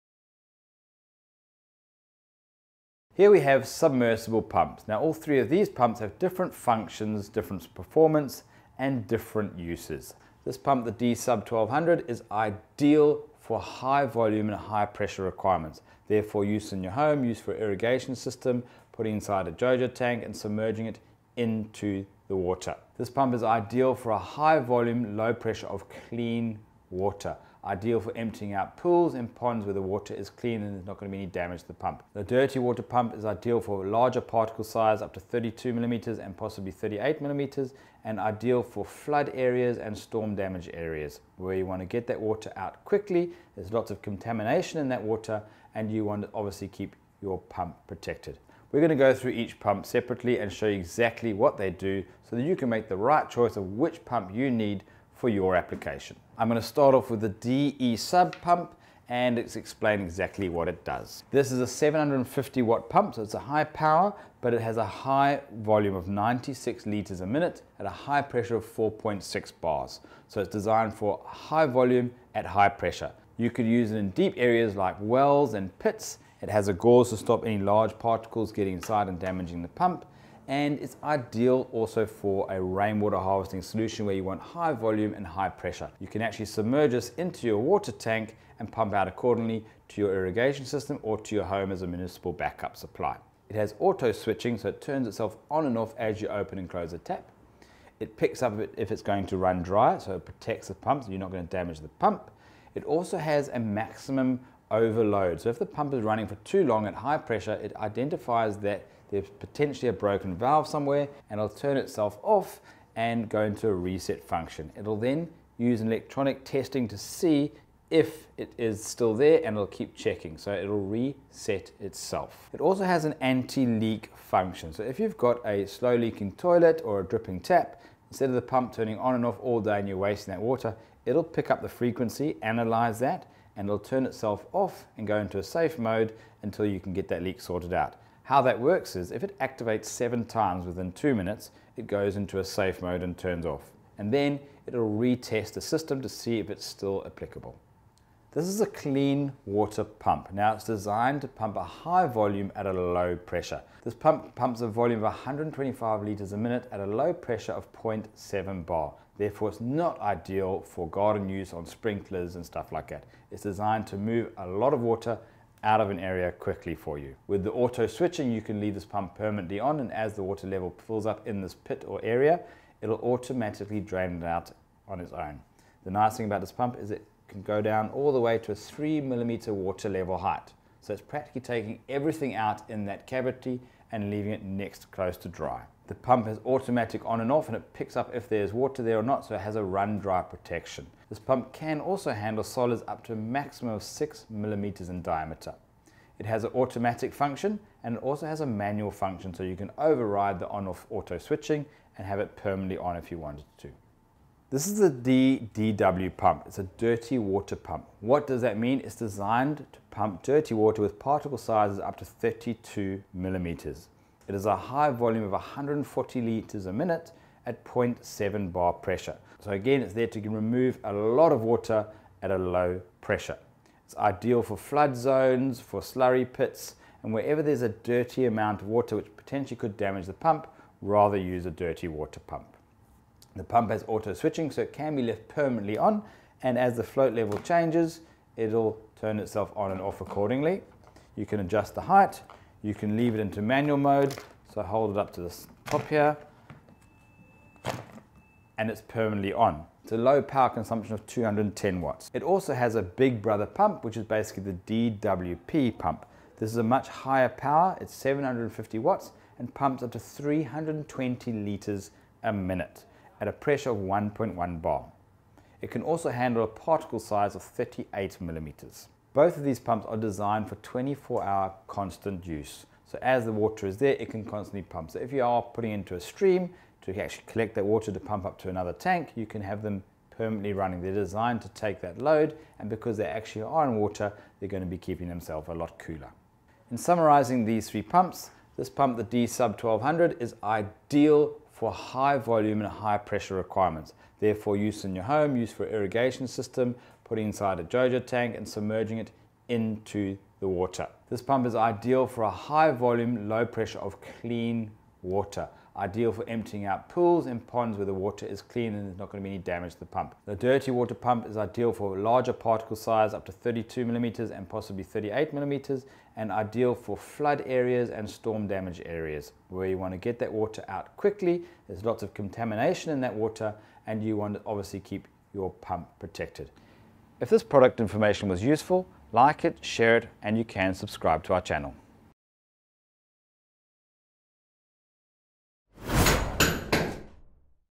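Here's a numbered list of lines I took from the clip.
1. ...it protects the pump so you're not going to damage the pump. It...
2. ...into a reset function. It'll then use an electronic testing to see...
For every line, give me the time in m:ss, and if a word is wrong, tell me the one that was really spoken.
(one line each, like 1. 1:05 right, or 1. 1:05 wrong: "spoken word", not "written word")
1. 1:40 right
2. 1:53 right.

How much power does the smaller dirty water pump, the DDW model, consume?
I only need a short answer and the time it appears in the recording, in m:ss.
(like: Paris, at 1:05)
210 watts, at 4:11.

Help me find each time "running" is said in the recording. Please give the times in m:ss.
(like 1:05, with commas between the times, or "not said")
1:46, 4:40.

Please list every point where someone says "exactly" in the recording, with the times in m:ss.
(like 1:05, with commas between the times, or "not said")
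0:50, 1:00.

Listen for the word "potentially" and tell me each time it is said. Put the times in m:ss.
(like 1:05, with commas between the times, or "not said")
1:49, 3:49.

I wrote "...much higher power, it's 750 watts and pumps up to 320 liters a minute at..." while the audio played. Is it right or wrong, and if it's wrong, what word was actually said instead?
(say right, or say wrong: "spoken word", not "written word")
right.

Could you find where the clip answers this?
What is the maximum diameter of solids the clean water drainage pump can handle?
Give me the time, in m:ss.
3:13.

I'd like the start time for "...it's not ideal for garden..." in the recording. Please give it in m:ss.
2:39.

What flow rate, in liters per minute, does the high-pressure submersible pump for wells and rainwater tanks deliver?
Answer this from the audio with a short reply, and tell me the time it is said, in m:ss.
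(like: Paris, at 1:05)
96 liters a minute, at 1:06.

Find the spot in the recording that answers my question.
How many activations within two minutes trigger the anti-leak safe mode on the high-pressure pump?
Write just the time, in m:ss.
2:19.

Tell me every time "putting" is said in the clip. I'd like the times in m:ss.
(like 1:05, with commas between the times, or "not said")
0:18, 4:35.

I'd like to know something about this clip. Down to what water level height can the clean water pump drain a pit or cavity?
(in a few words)
3 millimeters.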